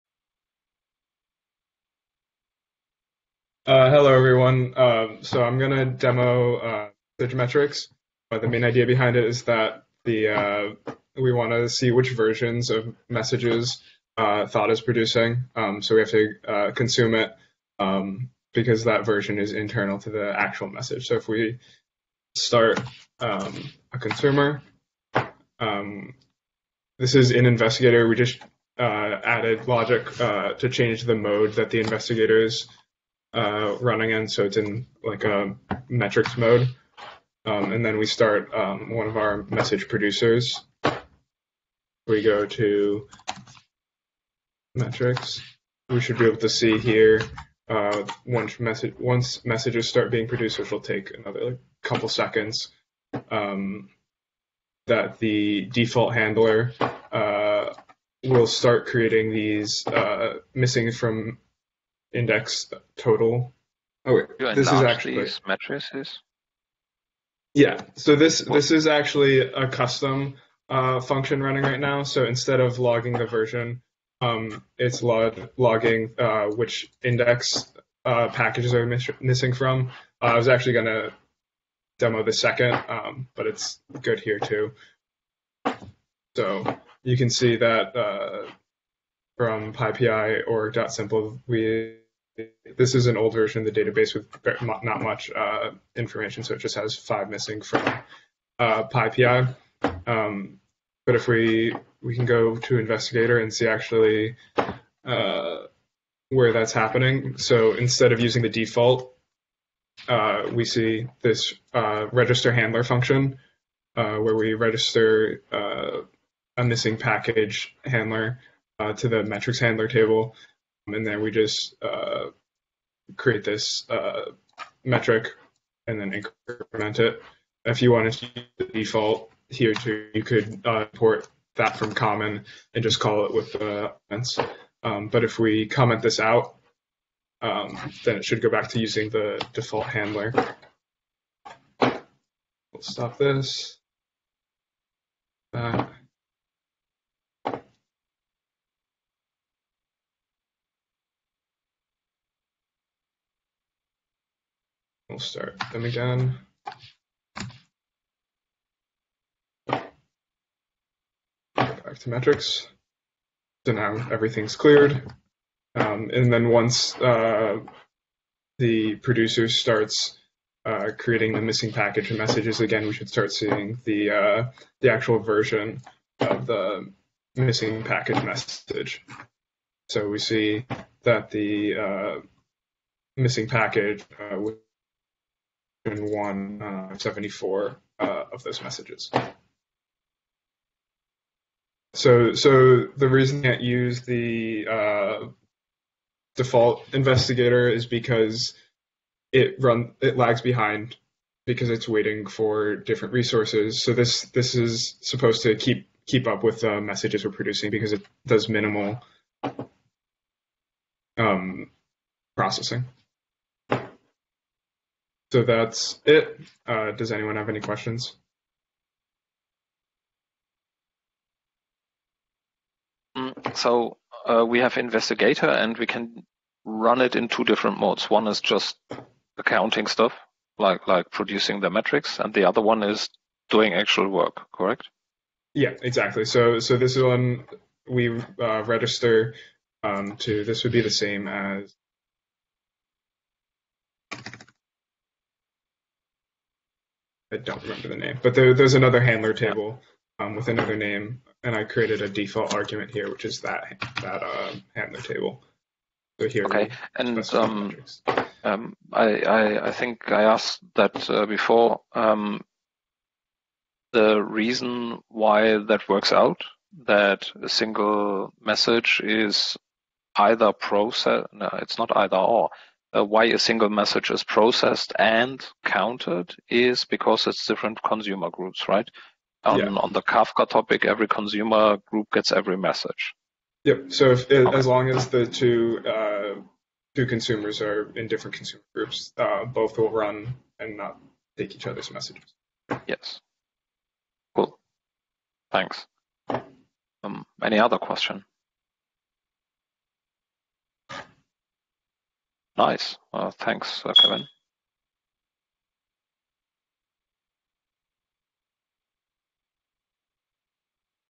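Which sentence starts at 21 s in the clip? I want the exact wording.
So if we start um, a consumer, um, this is in Investigator.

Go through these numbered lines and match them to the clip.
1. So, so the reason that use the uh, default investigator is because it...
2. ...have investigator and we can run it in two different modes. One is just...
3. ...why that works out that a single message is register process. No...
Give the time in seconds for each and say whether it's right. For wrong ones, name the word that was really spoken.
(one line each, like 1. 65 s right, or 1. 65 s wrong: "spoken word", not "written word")
1. 191 s right
2. 224 s right
3. 265 s wrong: "either", not "register".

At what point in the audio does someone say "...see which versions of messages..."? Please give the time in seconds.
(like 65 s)
11 s.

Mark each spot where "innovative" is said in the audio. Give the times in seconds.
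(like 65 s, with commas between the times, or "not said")
not said.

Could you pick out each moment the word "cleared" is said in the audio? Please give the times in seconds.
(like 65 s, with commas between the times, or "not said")
164 s.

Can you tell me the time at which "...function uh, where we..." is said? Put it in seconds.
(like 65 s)
112 s.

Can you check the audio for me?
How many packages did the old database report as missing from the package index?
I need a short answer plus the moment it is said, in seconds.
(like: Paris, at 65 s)
5, at 96 s.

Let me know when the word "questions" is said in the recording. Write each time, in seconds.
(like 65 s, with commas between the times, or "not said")
217 s, 297 s.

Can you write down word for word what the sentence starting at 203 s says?
So this this is supposed to keep keep up with the messages we're producing because it does minimal um, processing.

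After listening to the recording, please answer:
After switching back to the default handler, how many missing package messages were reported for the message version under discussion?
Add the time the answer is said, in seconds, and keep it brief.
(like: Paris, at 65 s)
174, at 185 s.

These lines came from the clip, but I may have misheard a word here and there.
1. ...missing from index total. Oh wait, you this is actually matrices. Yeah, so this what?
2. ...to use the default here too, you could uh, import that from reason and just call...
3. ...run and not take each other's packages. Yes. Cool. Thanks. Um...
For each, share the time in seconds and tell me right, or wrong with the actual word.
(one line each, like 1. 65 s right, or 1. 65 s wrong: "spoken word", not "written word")
1. 60 s right
2. 128 s wrong: "common", not "reason"
3. 289 s wrong: "messages", not "packages".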